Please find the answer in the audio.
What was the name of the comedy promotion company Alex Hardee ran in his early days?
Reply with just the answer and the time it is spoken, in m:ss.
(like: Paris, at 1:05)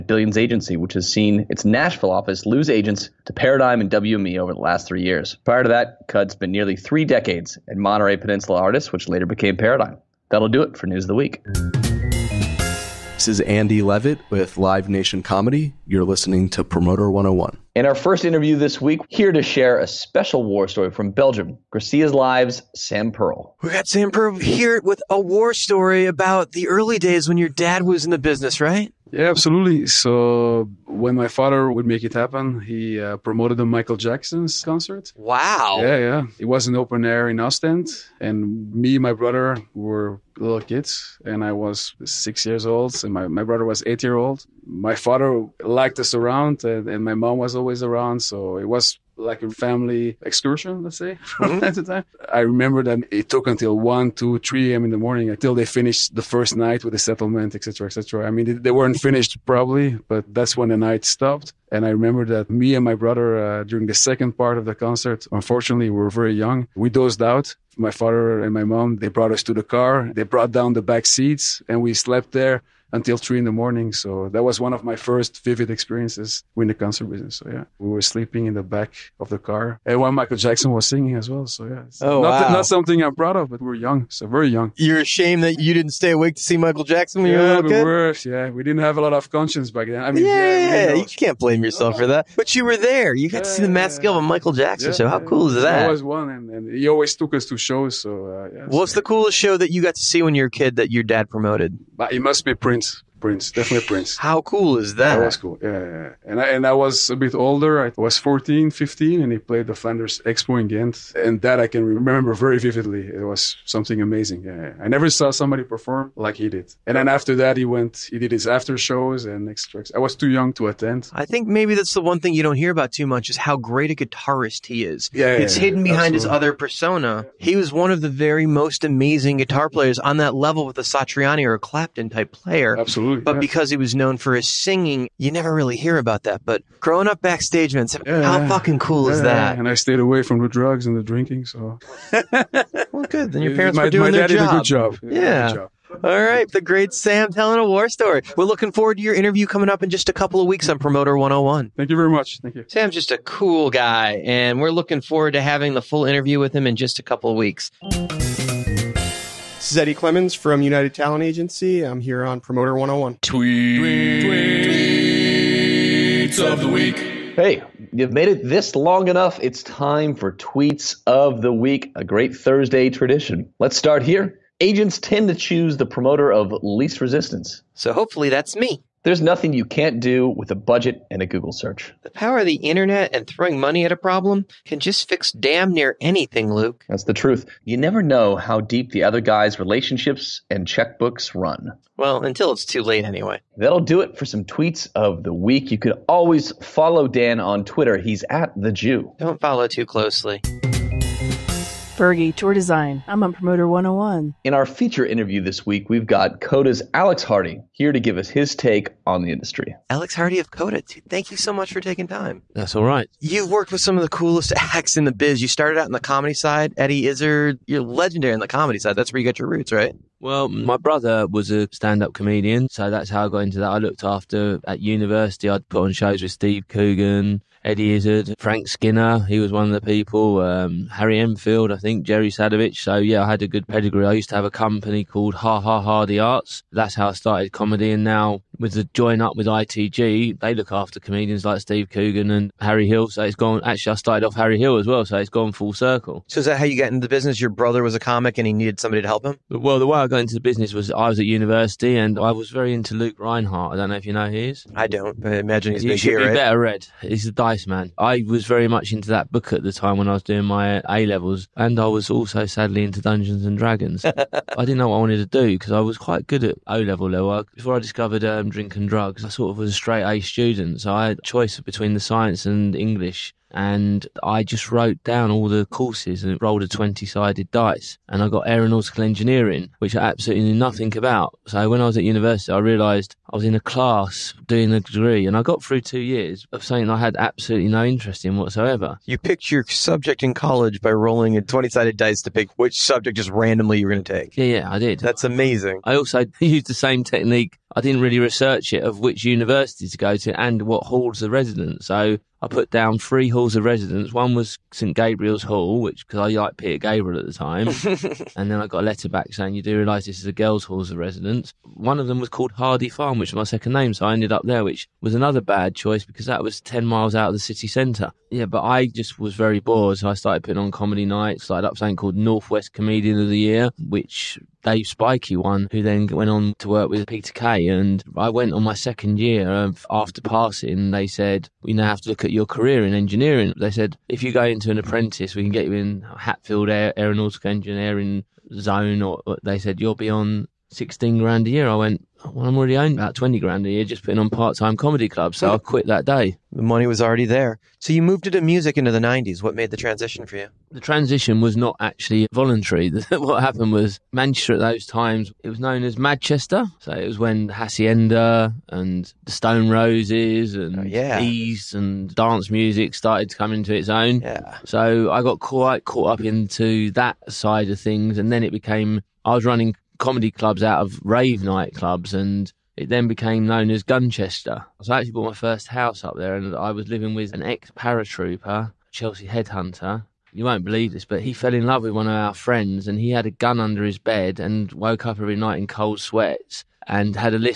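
Ha Ha Hardee Arts, at 3:55.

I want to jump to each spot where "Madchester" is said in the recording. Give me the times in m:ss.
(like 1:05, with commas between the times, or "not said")
5:55.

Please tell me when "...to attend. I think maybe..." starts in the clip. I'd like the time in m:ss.
2:00.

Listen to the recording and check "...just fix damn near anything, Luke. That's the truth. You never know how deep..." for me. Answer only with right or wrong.
right.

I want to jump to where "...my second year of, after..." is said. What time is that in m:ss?
5:28.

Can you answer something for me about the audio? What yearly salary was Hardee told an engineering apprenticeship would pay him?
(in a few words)
16 grand.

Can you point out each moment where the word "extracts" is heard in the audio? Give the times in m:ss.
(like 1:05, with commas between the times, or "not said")
1:59.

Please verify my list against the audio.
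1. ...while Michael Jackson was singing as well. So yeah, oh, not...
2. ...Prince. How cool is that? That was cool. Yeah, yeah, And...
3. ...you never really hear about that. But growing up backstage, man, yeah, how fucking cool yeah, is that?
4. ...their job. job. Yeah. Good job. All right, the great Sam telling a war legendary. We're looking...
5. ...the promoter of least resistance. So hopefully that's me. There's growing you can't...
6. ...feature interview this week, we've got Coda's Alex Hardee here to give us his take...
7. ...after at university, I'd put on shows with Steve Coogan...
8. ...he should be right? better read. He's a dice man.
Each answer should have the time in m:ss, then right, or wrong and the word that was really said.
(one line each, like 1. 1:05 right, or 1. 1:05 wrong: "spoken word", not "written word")
1. 1:19 right
2. 1:43 right
3. 2:15 right
4. 2:24 wrong: "story", not "legendary"
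5. 2:55 wrong: "nothing", not "growing"
6. 3:24 right
7. 3:44 right
8. 4:15 right.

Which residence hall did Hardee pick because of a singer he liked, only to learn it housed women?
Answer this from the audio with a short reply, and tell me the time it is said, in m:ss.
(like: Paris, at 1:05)
St Gabriel's Hall, at 5:04.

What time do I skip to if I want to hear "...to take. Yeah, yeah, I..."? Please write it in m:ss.
4:54.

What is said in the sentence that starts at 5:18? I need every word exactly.
Yeah, but I just was very bored, so I started putting on comedy nights.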